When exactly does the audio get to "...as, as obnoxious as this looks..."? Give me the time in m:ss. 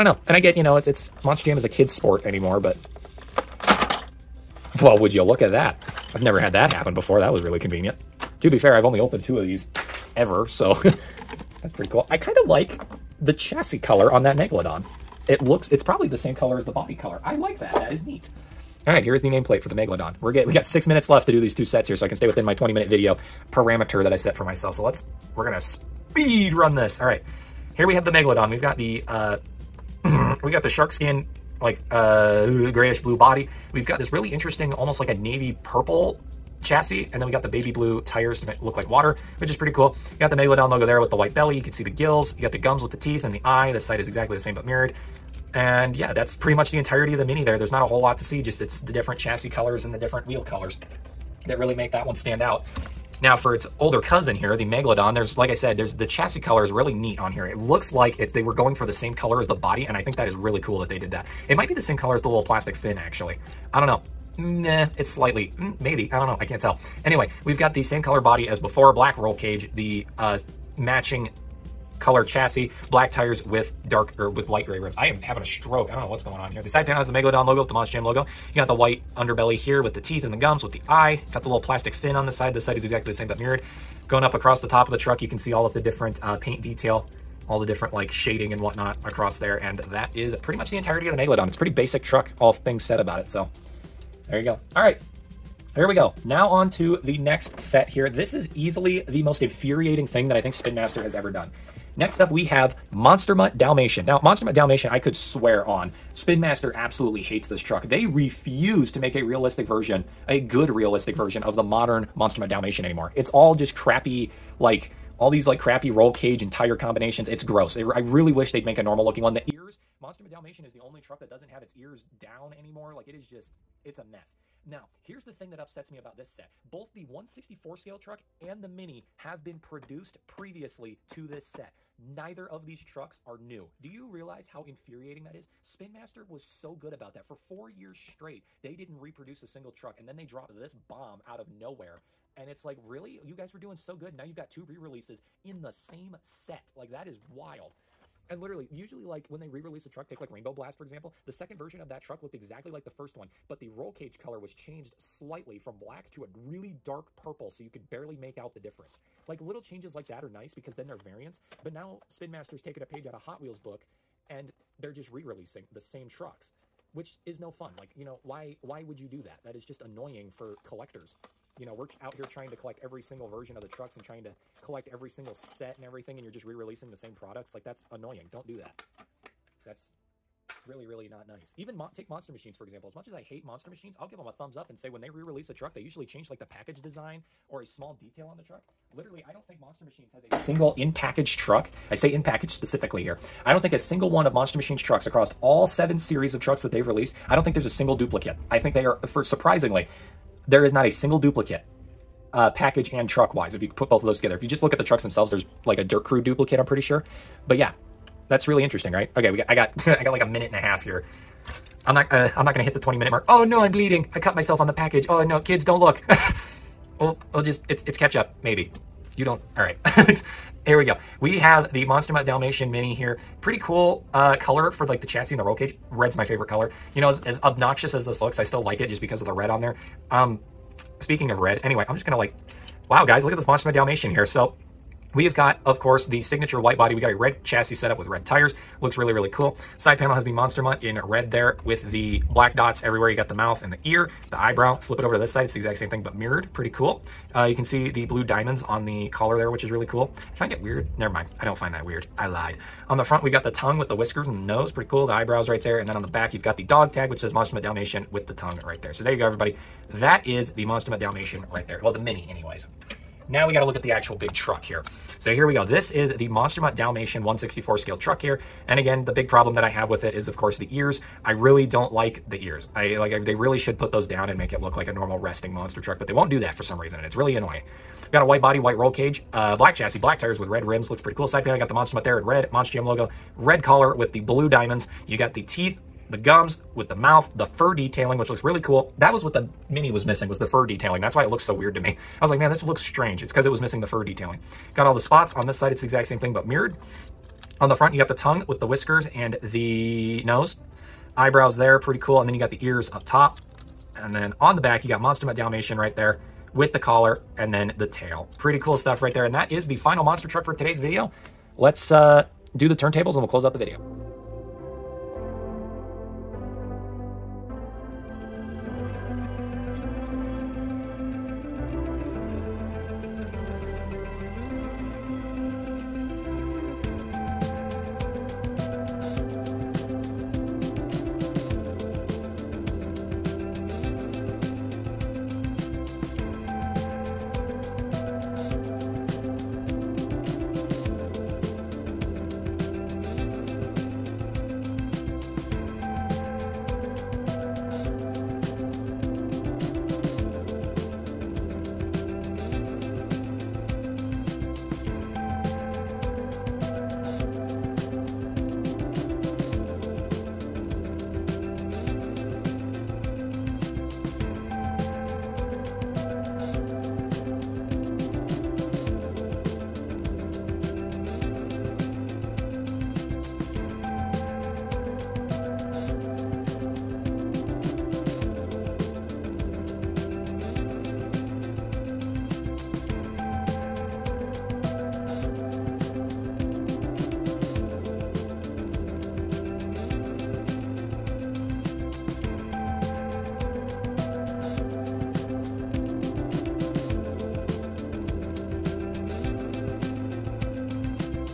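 3:47.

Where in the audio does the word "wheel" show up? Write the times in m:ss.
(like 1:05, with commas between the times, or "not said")
0:50, 2:43.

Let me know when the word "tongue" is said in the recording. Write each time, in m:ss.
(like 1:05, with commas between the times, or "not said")
4:13, 4:18, 4:58.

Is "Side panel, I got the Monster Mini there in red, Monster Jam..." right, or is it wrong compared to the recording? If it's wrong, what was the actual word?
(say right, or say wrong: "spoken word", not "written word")
wrong: "Mutt", not "Mini".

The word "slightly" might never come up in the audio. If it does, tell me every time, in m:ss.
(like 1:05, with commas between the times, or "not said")
1:05, 2:34.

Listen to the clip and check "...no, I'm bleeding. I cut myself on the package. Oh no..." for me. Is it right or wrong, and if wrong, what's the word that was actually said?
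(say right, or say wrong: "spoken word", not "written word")
right.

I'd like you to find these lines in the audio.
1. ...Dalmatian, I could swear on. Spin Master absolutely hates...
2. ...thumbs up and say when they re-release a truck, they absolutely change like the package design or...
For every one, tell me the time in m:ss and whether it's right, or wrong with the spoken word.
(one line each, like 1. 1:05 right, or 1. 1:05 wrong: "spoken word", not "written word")
1. 1:44 right
2. 3:04 wrong: "usually", not "absolutely".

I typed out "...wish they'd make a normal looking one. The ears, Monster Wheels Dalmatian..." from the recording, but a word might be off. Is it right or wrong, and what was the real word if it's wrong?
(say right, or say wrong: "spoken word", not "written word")
wrong: "Mutt", not "Wheels".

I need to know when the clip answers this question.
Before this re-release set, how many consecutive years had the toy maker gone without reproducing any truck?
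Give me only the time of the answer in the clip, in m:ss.
2:17.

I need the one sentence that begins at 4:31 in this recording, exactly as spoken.
I really don't like the ears.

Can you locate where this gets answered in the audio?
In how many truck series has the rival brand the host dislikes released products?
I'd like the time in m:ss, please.
3:15.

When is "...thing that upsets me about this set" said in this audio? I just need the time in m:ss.
2:05.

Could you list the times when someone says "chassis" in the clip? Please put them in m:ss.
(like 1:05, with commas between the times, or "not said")
0:13, 0:36, 0:49, 0:56, 1:12, 3:45, 3:57, 4:39.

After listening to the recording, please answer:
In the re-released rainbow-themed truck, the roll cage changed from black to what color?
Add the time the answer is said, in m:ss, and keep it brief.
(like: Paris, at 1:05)
Dark purple, at 2:36.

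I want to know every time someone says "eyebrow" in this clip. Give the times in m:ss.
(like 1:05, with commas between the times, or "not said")
4:04, 4:15, 5:01.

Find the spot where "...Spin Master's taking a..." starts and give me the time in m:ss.
2:42.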